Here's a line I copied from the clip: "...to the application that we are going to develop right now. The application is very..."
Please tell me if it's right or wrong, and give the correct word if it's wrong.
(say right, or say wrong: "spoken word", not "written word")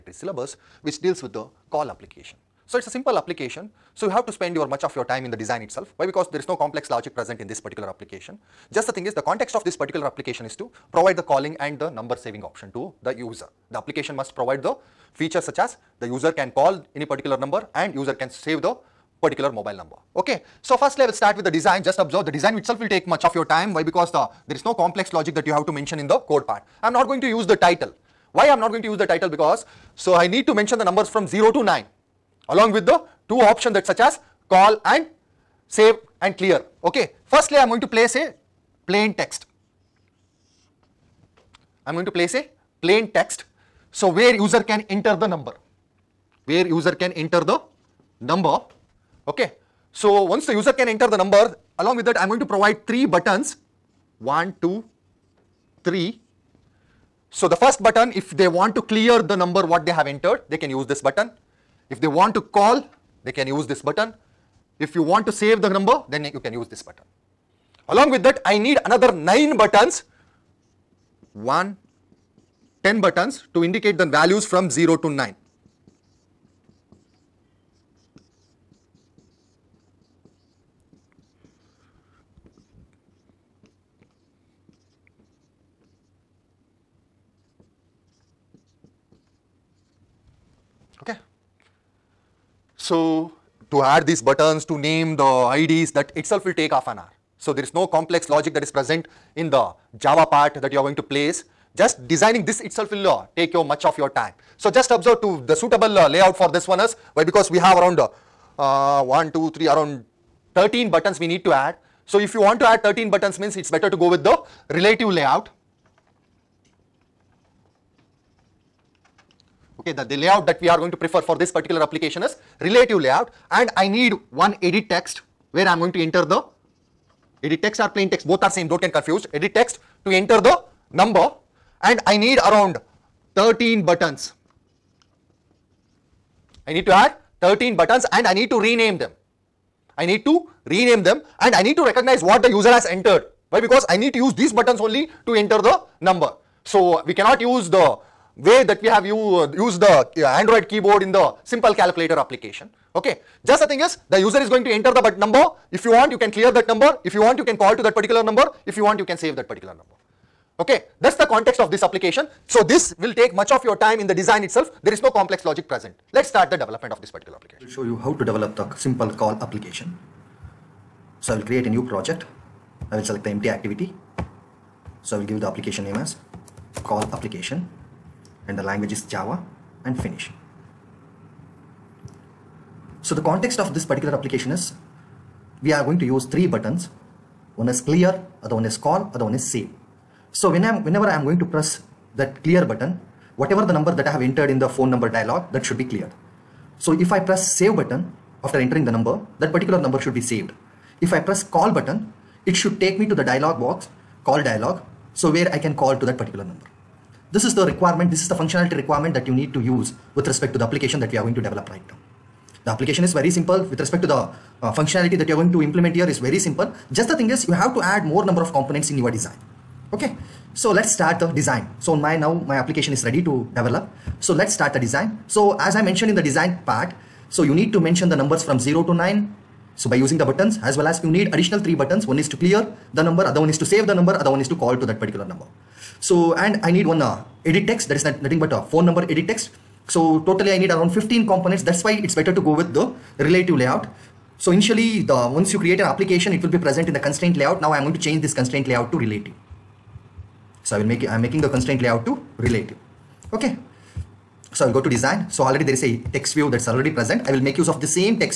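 right.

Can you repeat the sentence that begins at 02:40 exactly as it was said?
Okay, that's the context of this application.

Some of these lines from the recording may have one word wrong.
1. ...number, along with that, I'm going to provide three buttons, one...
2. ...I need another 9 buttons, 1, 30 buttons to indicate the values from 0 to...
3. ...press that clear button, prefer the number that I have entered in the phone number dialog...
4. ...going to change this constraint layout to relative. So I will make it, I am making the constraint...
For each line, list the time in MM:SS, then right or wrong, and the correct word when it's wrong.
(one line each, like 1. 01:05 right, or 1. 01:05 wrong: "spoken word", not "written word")
1. 00:51 right
2. 01:08 wrong: "10", not "30"
3. 03:11 wrong: "whatever", not "prefer"
4. 04:07 right.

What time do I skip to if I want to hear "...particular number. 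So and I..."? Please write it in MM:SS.
03:55.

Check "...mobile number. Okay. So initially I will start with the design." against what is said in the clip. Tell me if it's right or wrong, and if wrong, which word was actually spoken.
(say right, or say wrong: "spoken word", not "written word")
wrong: "firstly", not "initially".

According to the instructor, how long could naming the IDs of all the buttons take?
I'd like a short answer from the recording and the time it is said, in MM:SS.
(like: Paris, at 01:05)
half an hour, at 01:36.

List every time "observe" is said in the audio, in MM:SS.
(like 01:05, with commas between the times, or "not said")
00:21, 01:44.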